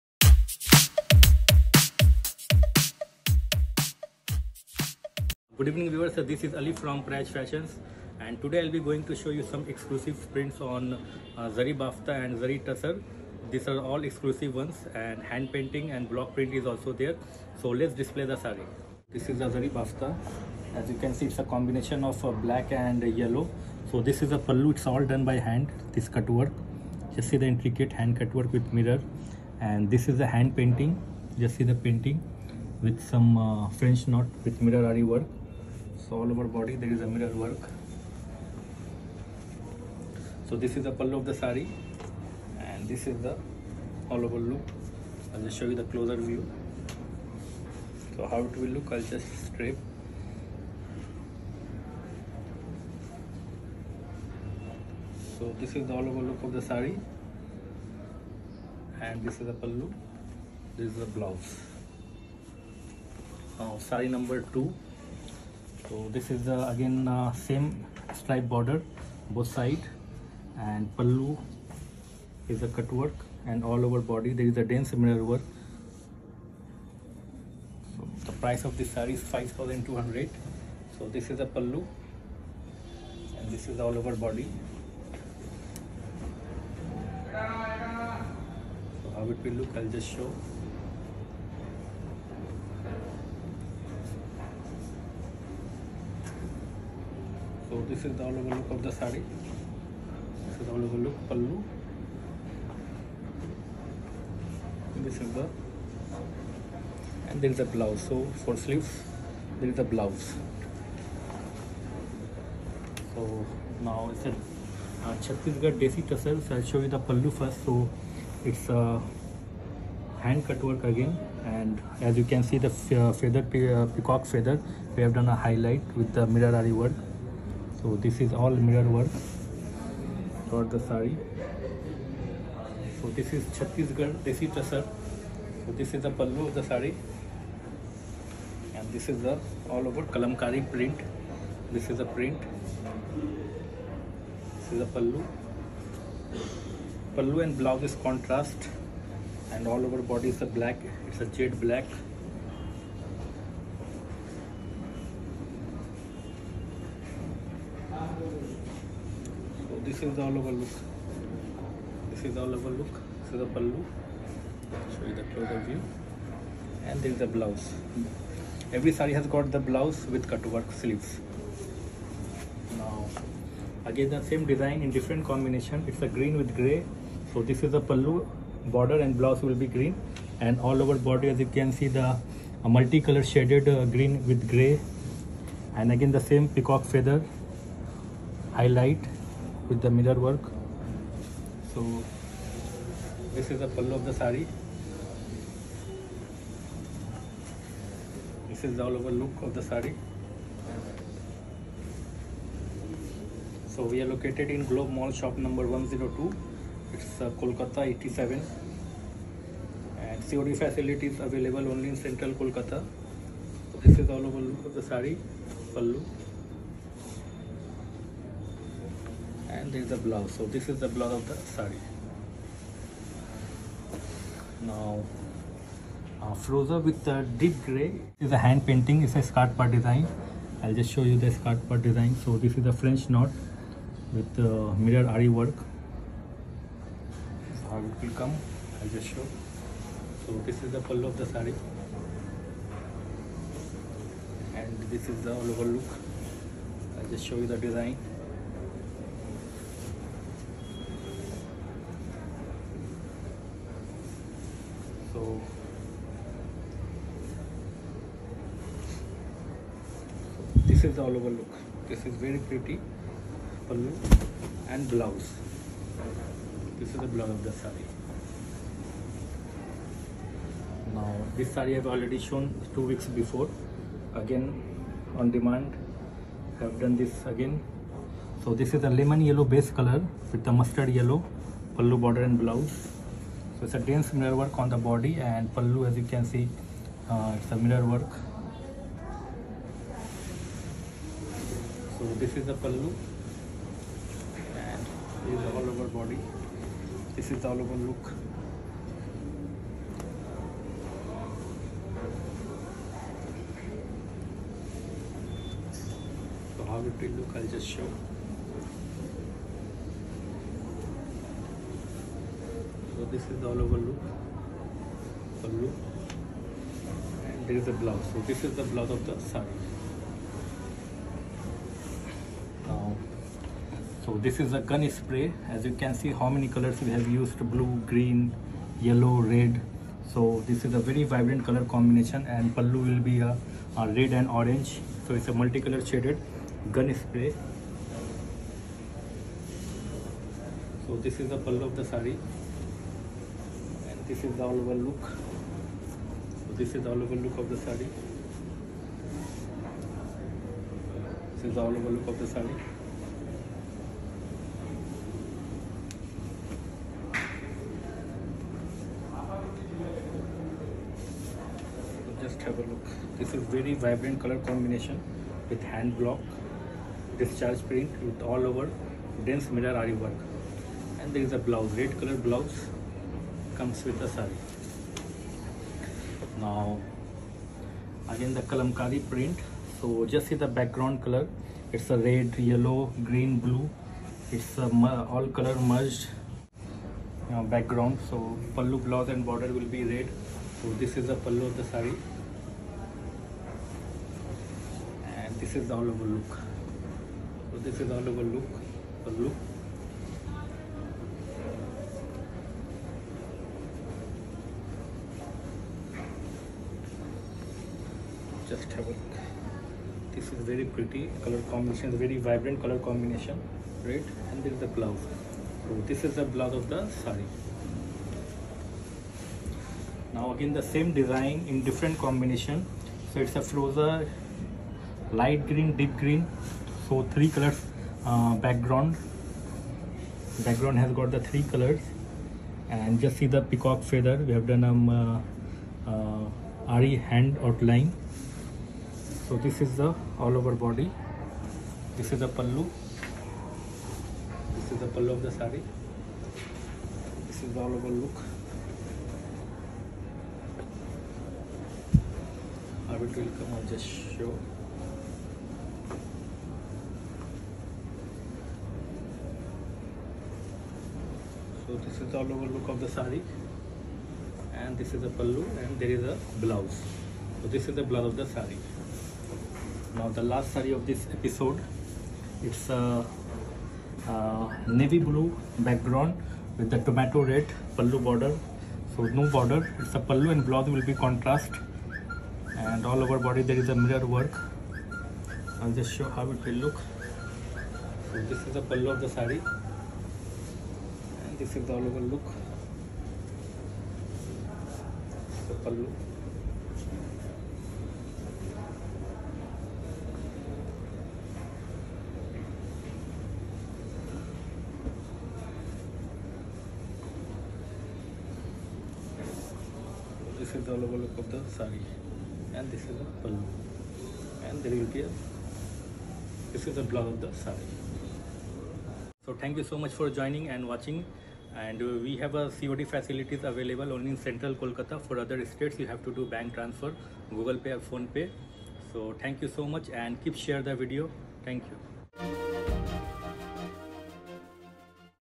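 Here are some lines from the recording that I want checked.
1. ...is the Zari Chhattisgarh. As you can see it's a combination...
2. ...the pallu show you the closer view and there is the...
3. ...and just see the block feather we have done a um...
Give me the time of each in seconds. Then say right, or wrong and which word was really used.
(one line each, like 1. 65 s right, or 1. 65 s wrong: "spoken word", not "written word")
1. 19 s wrong: "Bafta", not "Chhattisgarh"
2. 163 s right
3. 432 s wrong: "peacock", not "block".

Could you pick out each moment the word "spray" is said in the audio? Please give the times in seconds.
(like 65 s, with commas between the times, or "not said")
324 s, 337 s.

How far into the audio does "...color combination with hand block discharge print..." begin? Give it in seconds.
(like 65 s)
364 s.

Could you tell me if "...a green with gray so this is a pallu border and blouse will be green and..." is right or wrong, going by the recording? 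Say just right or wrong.
right.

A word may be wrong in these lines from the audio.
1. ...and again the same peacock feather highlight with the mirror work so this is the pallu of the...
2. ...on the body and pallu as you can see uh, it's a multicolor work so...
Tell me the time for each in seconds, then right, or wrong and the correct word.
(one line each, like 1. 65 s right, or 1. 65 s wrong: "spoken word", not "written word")
1. 185 s right
2. 284 s wrong: "mirror", not "multicolor".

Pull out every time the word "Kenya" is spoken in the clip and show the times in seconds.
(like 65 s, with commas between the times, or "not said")
not said.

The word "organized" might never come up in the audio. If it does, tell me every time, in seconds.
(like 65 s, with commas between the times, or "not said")
not said.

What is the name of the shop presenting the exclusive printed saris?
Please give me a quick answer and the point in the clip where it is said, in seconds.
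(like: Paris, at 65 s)
Prayash Fashions, at 7 s.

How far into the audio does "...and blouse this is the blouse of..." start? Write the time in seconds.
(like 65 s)
264 s.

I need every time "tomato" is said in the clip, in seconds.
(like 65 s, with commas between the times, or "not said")
476 s.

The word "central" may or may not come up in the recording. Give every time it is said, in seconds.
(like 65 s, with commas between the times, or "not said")
212 s, 524 s.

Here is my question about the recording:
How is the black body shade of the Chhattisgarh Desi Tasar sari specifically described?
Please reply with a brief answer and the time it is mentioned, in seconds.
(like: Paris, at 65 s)
Jade black, at 151 s.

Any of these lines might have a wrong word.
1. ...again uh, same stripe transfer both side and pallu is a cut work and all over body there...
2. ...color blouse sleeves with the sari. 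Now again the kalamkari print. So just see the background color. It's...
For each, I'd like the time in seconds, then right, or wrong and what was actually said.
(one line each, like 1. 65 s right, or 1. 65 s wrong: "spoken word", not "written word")
1. 66 s wrong: "border", not "transfer"
2. 372 s wrong: "comes", not "sleeves".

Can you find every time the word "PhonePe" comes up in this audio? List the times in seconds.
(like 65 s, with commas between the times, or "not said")
527 s.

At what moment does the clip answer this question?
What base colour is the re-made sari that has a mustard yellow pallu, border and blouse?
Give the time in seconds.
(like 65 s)
278 s.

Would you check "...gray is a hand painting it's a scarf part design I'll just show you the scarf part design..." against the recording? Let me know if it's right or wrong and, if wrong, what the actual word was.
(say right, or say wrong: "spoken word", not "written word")
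right.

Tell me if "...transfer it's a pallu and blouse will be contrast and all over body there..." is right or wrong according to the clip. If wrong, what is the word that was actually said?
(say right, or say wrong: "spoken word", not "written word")
wrong: "border", not "transfer".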